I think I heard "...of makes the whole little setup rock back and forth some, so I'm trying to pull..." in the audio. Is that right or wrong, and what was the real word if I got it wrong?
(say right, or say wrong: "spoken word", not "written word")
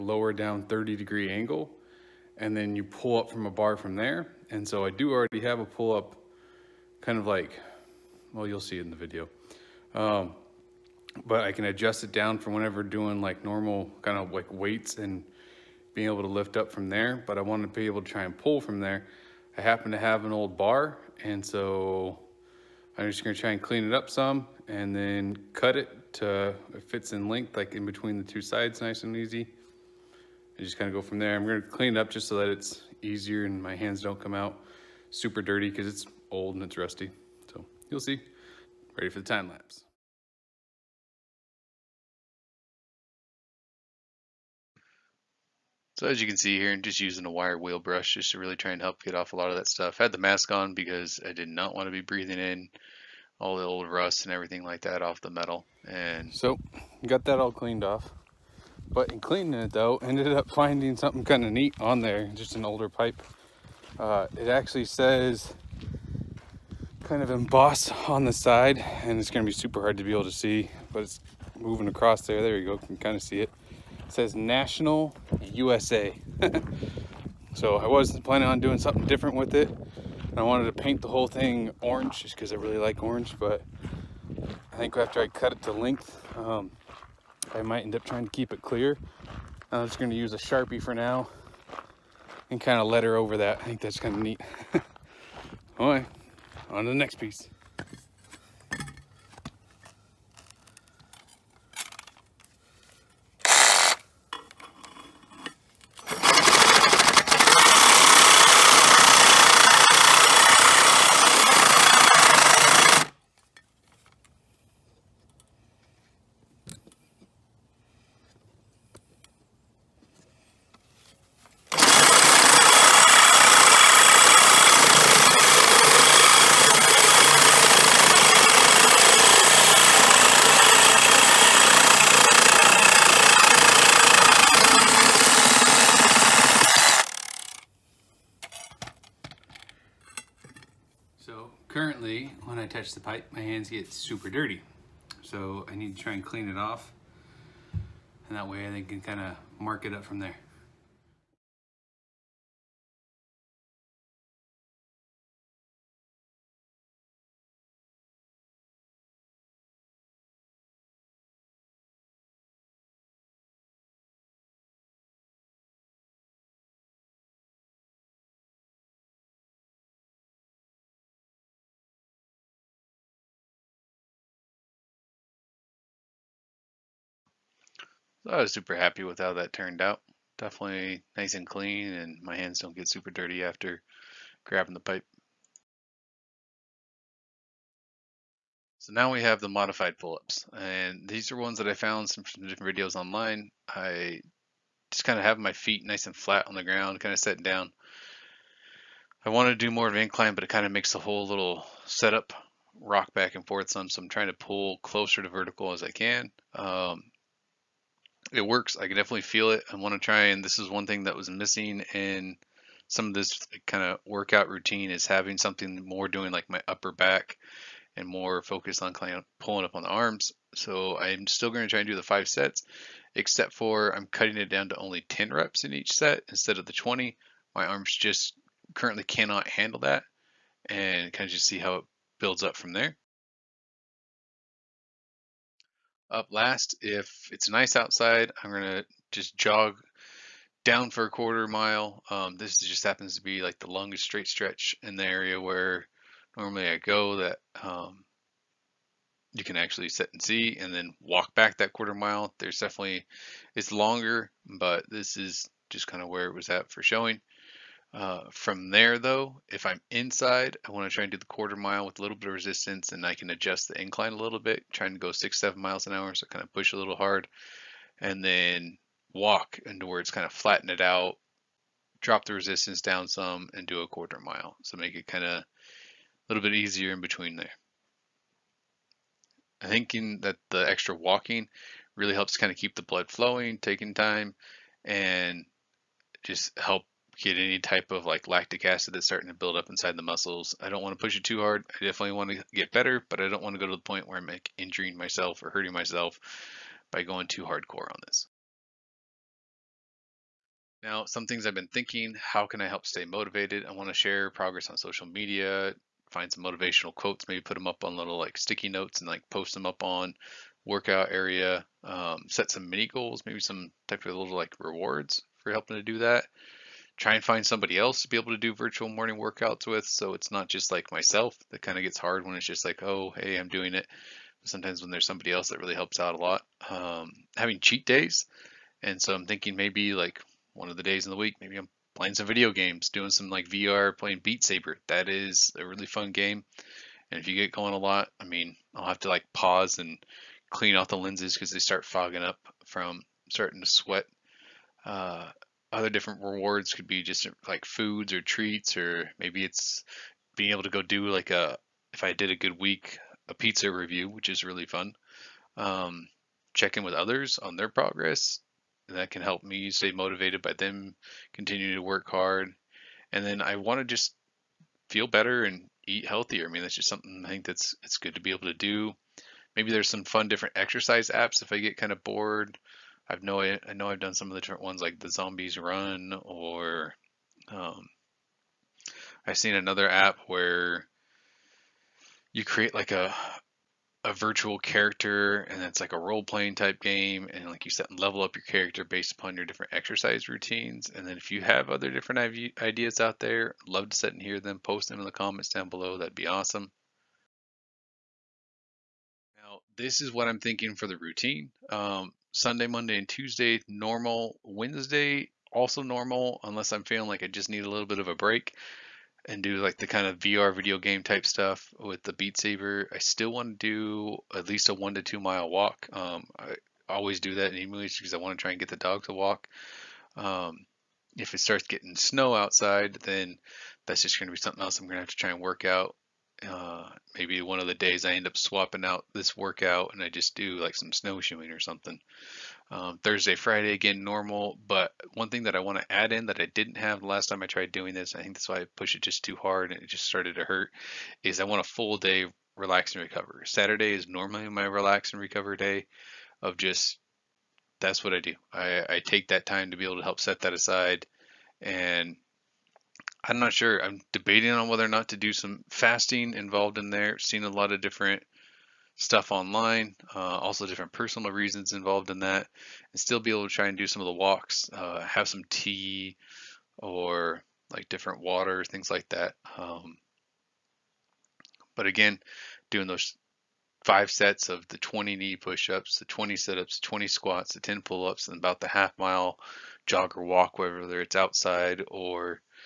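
right.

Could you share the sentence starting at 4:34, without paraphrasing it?
So make it kind of a little bit easier in between there.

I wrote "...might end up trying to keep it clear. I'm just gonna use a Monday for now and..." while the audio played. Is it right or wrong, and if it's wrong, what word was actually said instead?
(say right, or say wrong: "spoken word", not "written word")
wrong: "Sharpie", not "Monday".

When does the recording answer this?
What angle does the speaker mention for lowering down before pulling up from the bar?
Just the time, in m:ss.
0:00.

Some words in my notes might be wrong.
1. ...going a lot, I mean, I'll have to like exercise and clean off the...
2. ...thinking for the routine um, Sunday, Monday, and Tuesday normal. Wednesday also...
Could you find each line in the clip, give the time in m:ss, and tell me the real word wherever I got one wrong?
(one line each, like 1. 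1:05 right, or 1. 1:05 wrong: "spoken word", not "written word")
1. 5:37 wrong: "pause", not "exercise"
2. 6:40 right.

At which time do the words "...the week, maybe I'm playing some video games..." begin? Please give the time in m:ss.
5:31.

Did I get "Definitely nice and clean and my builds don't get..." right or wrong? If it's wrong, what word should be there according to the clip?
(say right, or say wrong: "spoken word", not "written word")
wrong: "hands", not "builds".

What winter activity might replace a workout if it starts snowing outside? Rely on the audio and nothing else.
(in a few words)
Snowshoeing.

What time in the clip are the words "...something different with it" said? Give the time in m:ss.
1:18.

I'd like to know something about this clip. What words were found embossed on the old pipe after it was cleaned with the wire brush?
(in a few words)
National USA.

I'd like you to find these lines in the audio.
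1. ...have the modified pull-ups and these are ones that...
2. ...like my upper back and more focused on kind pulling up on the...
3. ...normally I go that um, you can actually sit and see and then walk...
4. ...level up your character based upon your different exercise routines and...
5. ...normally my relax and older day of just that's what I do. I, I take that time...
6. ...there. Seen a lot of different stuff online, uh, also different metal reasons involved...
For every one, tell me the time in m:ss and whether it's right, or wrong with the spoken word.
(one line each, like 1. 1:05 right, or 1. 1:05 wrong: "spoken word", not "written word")
1. 3:09 right
2. 3:36 right
3. 4:06 right
4. 6:28 right
5. 7:24 wrong: "recover", not "older"
6. 7:36 wrong: "personal", not "metal".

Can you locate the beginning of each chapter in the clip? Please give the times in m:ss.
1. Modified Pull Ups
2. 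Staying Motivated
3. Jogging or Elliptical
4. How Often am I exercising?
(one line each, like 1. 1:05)
1. 3:06
2. 4:59
3. 3:54
4. 6:38.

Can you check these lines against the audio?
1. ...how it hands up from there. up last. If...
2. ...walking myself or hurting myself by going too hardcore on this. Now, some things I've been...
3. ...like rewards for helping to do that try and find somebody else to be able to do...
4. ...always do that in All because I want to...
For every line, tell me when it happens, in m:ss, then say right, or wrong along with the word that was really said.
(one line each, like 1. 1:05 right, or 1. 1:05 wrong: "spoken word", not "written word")
1. 3:51 wrong: "builds", not "hands"
2. 4:54 wrong: "injuring", not "walking"
3. 5:14 right
4. 6:56 wrong: "English", not "All".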